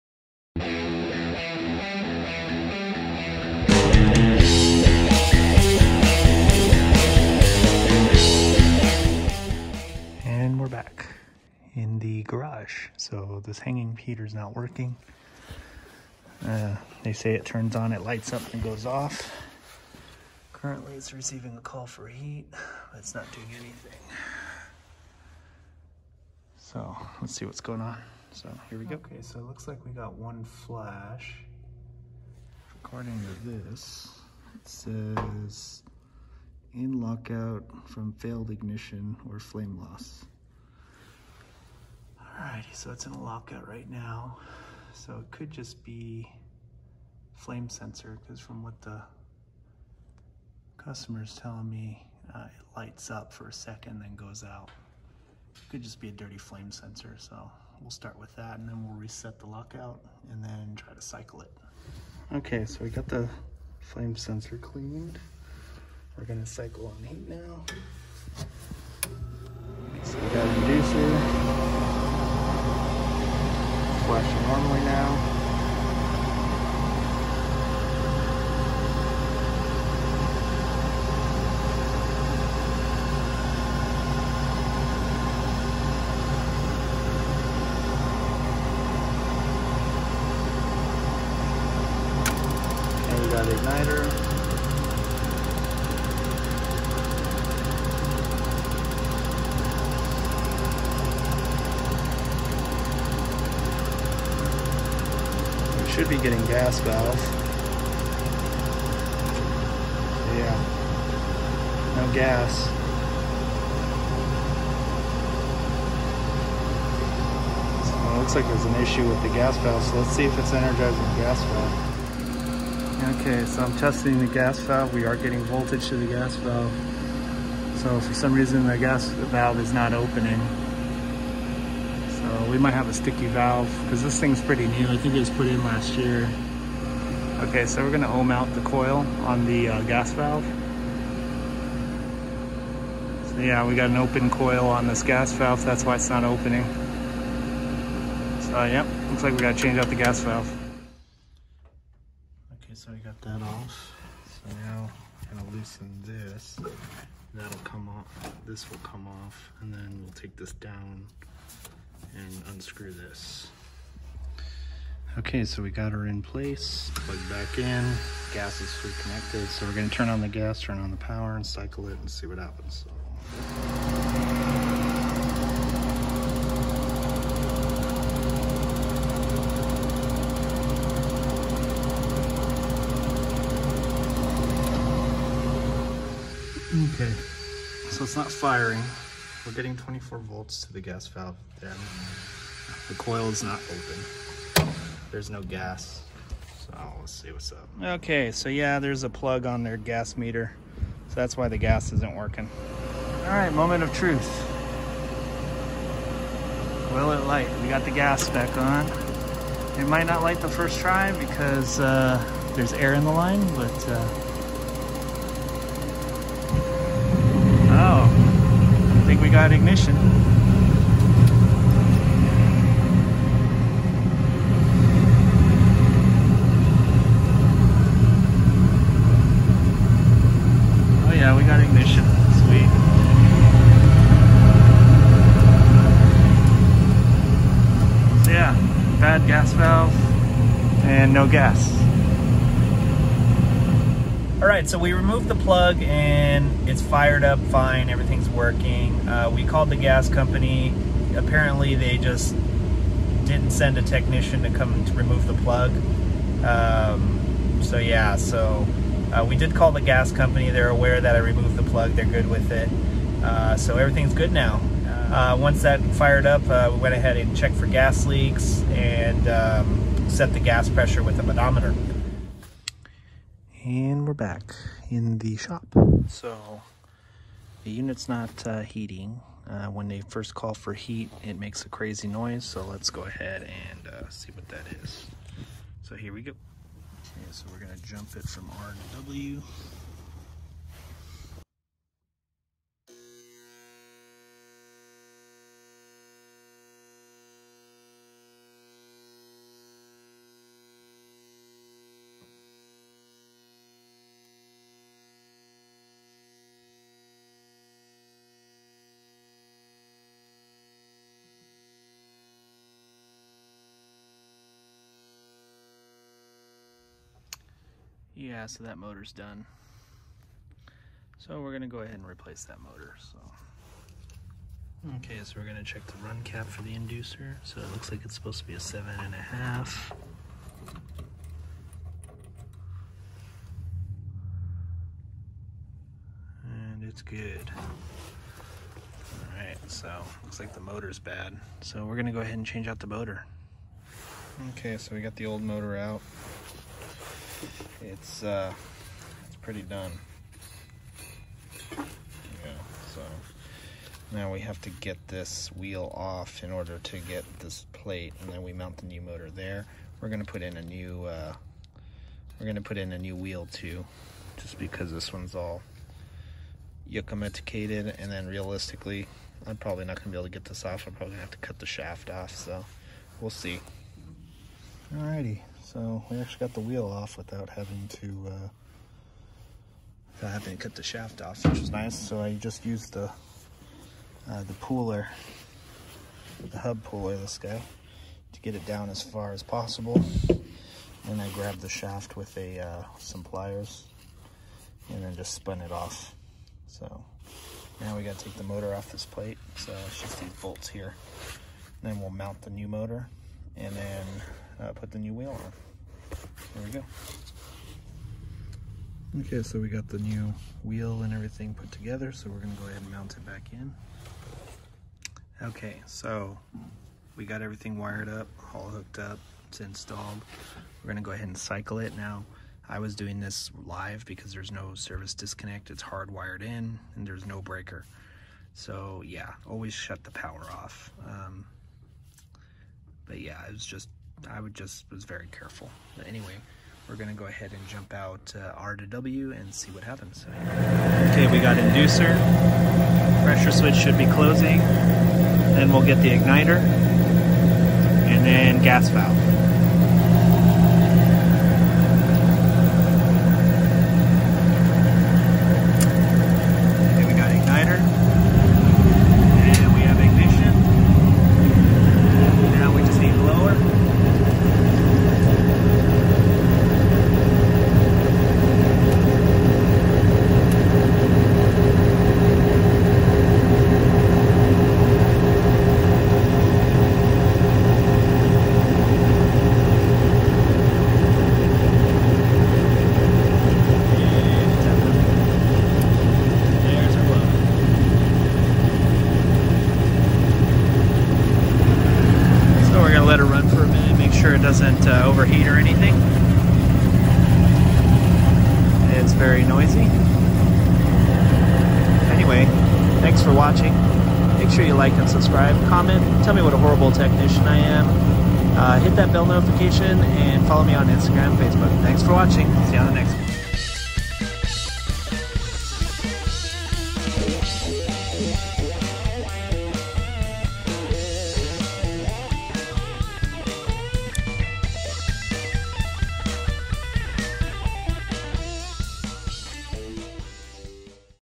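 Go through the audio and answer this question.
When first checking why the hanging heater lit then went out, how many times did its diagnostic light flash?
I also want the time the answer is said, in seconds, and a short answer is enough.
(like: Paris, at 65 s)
1, at 30 s.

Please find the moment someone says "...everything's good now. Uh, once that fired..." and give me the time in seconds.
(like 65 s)
263 s.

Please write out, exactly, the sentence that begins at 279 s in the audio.
Uh, when they first call for heat, it makes a crazy noise.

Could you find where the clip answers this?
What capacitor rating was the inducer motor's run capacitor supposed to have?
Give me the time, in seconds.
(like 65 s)
328 s.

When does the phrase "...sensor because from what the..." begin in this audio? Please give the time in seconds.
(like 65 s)
47 s.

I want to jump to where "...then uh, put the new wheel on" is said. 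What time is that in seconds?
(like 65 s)
403 s.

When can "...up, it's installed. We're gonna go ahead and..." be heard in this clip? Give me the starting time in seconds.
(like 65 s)
418 s.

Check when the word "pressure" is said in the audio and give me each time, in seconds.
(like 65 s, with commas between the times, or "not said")
270 s, 443 s.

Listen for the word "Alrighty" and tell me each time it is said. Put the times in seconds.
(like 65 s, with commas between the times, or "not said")
42 s, 374 s.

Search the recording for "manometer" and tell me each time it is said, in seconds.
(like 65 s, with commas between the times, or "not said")
271 s.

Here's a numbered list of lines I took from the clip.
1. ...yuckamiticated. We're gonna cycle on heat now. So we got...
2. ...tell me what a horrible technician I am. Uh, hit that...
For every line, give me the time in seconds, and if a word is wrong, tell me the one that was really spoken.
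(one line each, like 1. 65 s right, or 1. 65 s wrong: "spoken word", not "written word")
1. 64 s wrong: "cleaned", not "yuckamiticated"
2. 506 s right.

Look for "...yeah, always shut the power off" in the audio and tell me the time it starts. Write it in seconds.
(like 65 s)
429 s.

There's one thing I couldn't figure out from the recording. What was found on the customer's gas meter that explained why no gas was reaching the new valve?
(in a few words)
A plug.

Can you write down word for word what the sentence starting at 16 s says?
Uh, they say it turns on, it lights up and goes off.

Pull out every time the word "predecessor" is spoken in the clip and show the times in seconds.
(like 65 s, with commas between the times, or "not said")
not said.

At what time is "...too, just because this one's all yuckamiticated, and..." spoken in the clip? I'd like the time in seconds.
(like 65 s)
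363 s.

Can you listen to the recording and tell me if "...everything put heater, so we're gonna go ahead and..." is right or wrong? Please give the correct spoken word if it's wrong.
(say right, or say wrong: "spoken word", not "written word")
wrong: "together", not "heater".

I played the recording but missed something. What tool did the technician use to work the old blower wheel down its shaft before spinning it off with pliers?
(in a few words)
Hub puller.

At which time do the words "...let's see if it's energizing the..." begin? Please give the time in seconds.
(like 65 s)
119 s.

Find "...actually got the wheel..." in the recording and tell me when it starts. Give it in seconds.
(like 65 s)
376 s.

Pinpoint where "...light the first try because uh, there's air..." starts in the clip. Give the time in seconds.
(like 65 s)
210 s.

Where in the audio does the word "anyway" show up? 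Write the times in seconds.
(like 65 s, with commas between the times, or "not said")
436 s, 502 s.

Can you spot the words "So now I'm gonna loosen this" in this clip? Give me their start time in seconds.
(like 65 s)
154 s.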